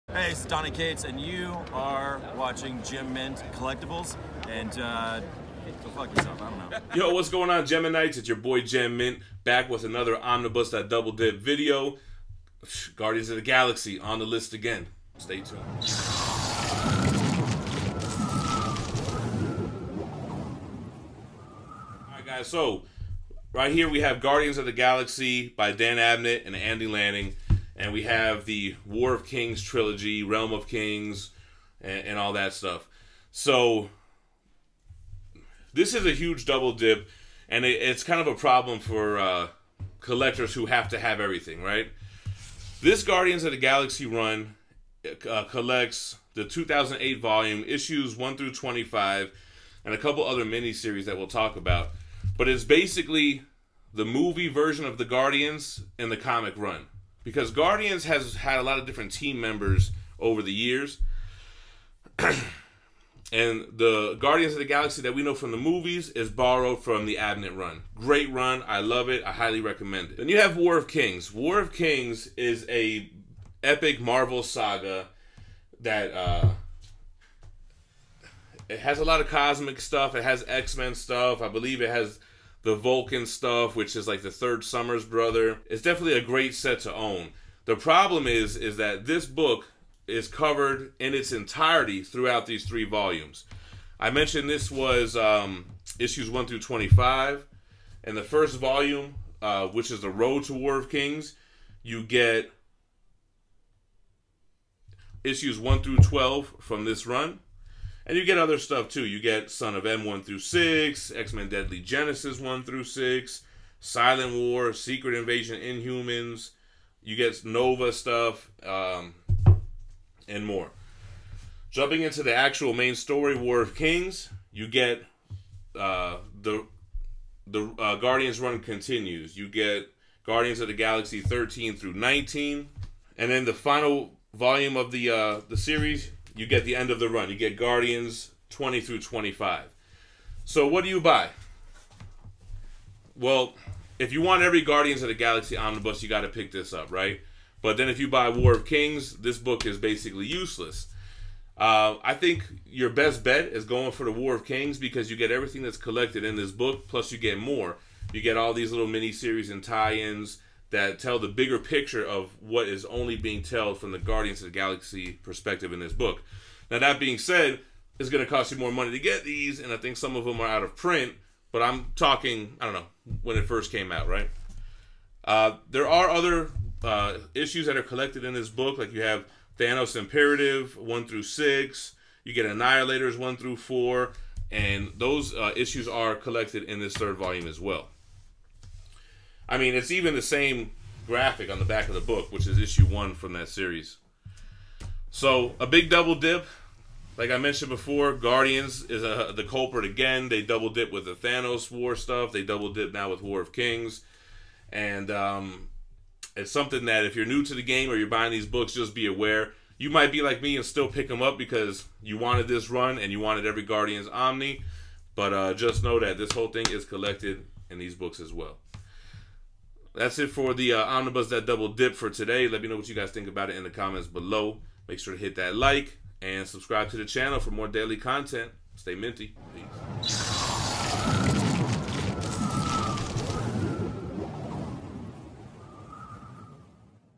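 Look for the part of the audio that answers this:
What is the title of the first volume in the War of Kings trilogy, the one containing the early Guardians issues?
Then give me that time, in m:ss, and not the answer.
1:40.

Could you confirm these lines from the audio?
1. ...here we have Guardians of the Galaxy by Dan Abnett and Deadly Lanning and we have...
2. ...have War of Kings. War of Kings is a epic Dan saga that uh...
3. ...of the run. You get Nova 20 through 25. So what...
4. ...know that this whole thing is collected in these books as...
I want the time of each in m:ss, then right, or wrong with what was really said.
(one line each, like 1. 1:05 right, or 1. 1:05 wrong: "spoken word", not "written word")
1. 0:23 wrong: "Andy", not "Deadly"
2. 1:10 wrong: "Marvel", not "Dan"
3. 2:16 wrong: "Guardians", not "Nova"
4. 3:35 right.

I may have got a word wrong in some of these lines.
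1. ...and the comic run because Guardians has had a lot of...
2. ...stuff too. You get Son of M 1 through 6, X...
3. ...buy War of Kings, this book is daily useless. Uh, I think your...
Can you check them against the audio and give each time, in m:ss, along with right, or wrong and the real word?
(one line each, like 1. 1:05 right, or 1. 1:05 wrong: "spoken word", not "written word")
1. 0:55 right
2. 1:48 right
3. 2:28 wrong: "basically", not "daily".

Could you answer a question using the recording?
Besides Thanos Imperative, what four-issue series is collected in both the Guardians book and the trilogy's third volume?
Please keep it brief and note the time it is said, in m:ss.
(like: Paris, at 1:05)
Annihilators, at 3:02.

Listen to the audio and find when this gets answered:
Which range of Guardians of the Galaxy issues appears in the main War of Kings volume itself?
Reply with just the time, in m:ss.
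2:11.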